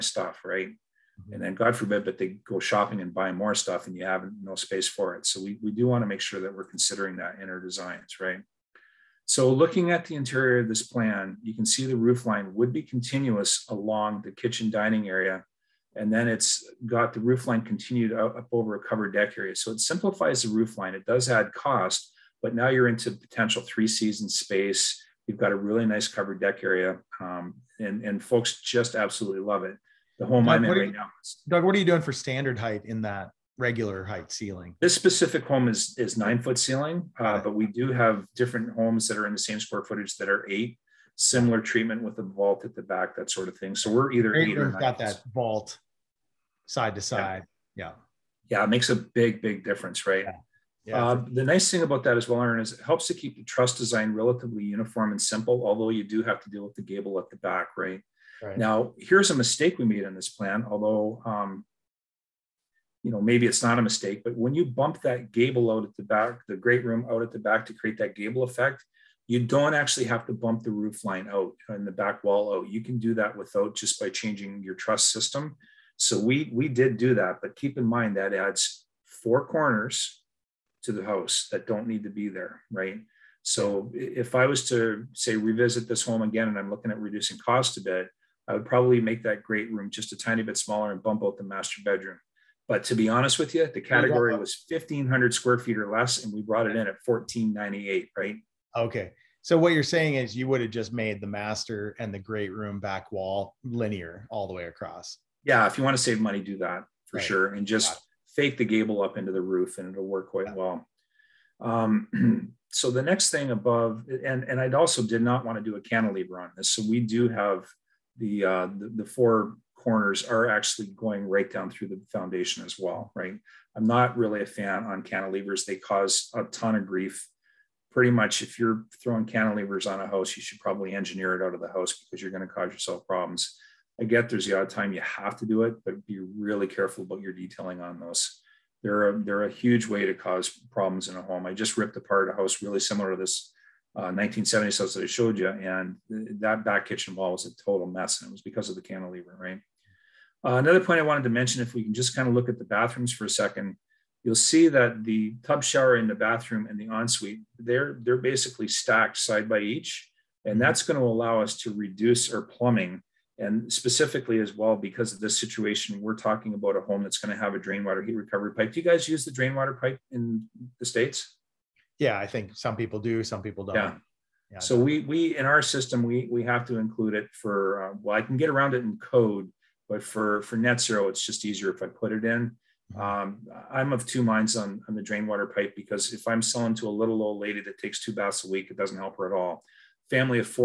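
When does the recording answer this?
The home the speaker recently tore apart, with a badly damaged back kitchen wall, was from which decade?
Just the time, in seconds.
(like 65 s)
144 s.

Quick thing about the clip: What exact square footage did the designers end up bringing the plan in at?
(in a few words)
1498.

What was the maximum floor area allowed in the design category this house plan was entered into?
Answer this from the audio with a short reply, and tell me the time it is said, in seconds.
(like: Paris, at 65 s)
1500 square feet, at 94 s.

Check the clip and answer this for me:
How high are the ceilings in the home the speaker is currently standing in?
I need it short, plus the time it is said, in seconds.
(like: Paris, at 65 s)
9 foot, at 36 s.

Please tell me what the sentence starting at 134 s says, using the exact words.
I get there's the odd time you have to do it, but be really careful about your detailing on those.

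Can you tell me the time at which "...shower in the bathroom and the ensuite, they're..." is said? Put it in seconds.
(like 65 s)
155 s.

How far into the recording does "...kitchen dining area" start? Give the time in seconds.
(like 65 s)
14 s.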